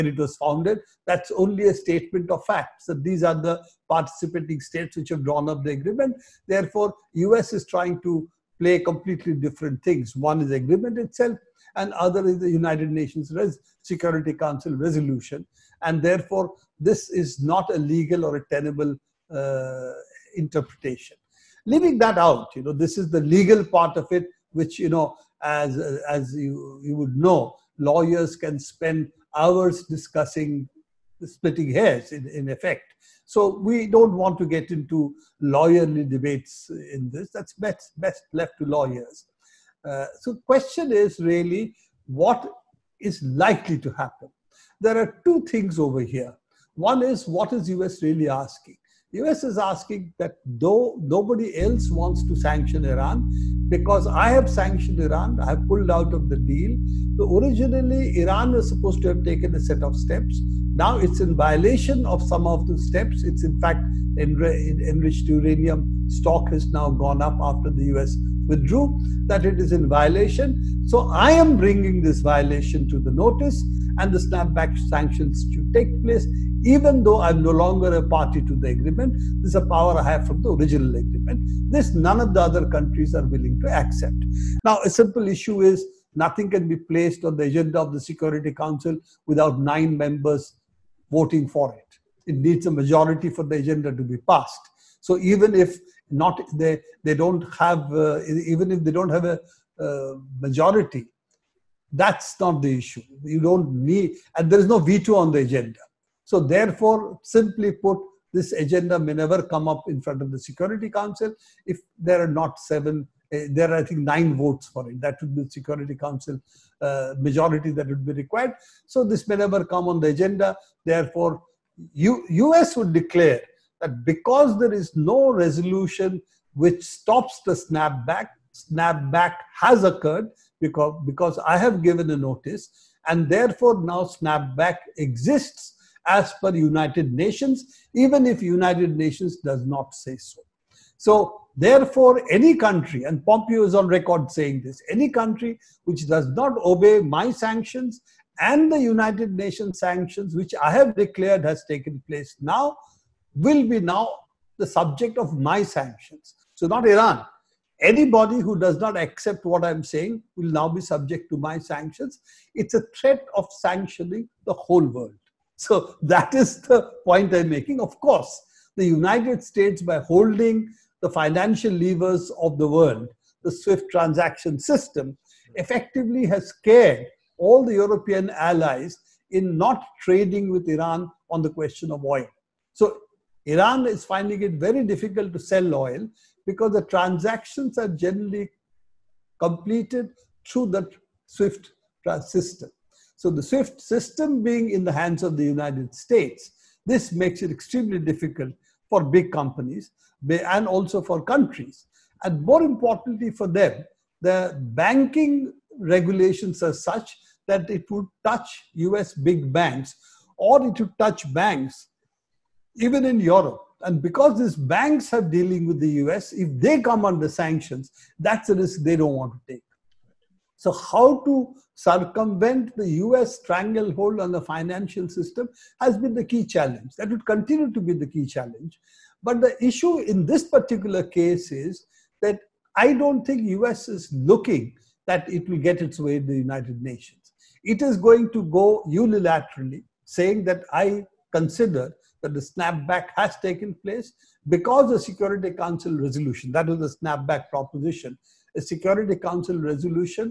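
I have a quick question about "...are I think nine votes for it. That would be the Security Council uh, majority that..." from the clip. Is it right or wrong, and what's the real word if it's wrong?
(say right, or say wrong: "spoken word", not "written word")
right.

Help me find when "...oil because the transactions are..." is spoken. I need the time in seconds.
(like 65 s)
185 s.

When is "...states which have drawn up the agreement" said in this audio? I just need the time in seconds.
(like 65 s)
4 s.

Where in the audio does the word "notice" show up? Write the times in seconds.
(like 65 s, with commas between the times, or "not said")
73 s, 132 s.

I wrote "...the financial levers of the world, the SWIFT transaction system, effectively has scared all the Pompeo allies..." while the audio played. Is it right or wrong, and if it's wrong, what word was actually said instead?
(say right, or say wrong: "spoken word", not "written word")
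wrong: "European", not "Pompeo".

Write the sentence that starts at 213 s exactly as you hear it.
And because these banks are dealing with the US, if they come under sanctions, that's a risk they don't want to take.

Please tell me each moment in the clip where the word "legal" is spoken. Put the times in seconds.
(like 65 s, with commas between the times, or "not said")
17 s, 23 s.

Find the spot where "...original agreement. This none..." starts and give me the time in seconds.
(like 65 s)
80 s.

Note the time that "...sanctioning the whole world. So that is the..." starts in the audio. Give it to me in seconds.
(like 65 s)
163 s.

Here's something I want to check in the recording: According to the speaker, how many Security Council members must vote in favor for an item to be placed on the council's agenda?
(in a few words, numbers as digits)
9.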